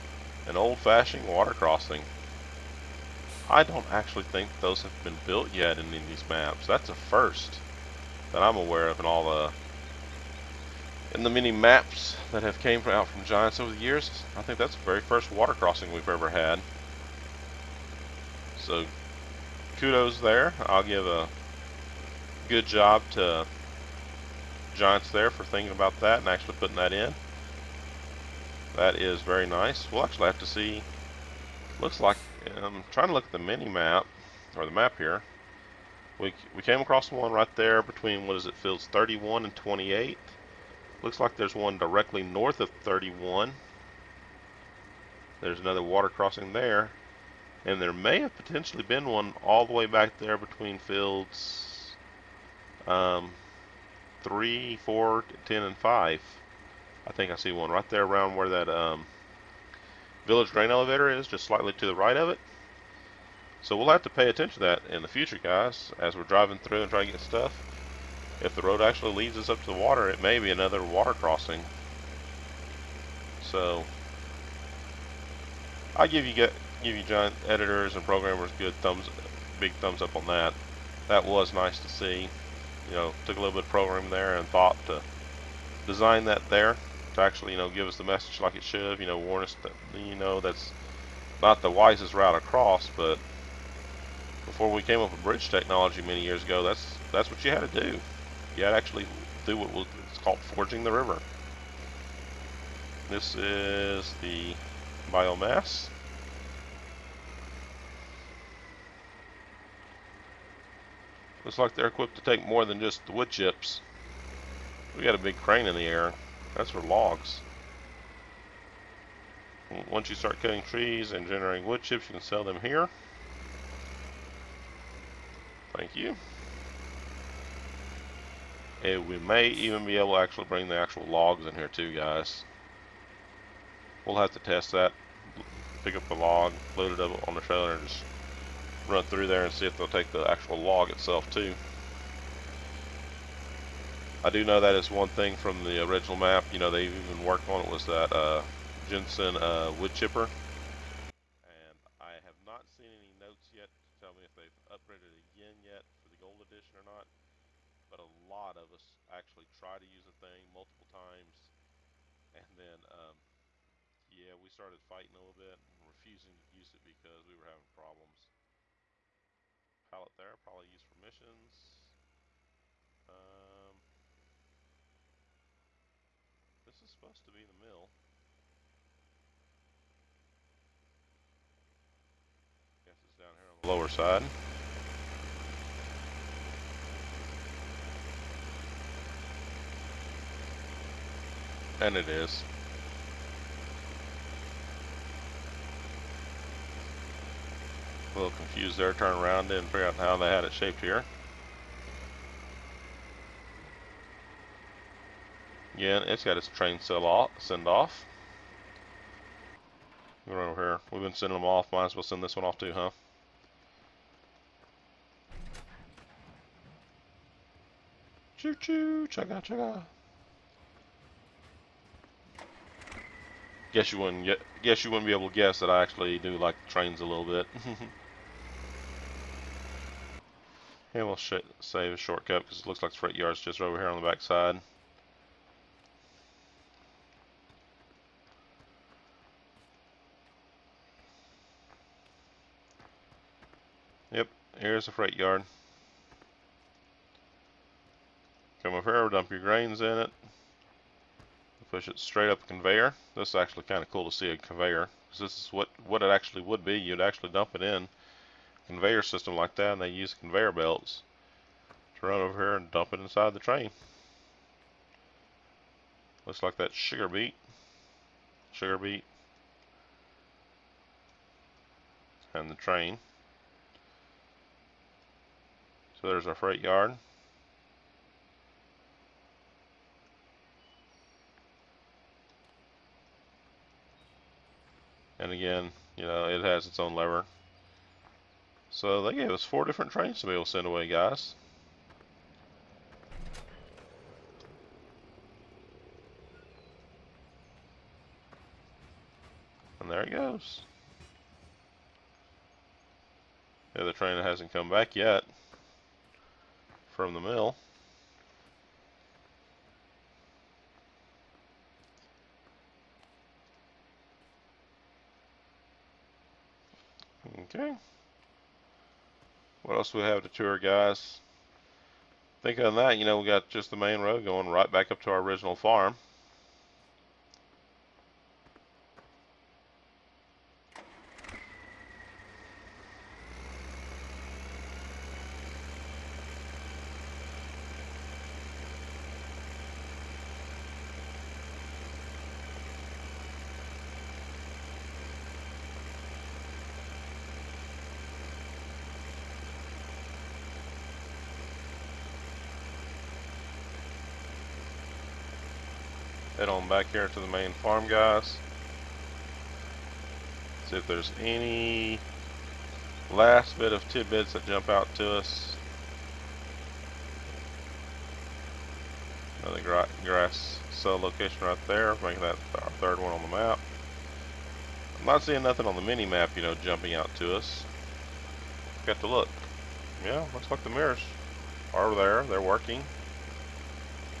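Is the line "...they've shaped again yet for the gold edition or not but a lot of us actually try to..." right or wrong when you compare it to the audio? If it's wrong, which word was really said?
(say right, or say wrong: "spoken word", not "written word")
wrong: "upgraded", not "shaped".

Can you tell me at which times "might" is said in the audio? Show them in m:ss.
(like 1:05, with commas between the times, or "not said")
3:31.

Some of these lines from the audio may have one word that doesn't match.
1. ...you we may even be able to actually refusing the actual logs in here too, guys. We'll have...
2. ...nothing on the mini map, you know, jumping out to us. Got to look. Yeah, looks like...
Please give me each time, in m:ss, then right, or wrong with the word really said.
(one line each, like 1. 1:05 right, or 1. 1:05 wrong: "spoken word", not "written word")
1. 2:05 wrong: "bring", not "refusing"
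2. 6:15 right.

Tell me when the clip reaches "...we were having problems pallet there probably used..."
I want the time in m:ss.
2:47.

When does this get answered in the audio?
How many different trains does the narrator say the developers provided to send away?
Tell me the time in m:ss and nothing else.
4:49.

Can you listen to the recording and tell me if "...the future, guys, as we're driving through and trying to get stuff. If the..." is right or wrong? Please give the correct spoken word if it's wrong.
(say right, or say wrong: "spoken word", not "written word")
right.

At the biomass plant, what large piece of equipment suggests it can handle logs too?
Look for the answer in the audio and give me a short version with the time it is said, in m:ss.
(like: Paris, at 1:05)
big crane, at 1:55.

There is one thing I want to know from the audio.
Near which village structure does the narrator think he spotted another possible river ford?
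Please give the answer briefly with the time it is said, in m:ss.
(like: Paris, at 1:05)
grain elevator, at 1:00.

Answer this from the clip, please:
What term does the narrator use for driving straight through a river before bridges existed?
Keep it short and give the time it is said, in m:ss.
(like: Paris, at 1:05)
forging the river, at 1:40.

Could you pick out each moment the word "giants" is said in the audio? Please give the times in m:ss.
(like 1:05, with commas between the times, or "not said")
0:13, 0:24, 1:17.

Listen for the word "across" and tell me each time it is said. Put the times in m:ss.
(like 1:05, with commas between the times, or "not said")
0:36, 1:32.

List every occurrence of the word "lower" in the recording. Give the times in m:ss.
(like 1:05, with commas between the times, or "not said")
3:03.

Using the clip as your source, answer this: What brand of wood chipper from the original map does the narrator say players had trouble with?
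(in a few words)
Jensen.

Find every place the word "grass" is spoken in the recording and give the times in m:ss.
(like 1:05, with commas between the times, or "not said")
6:10.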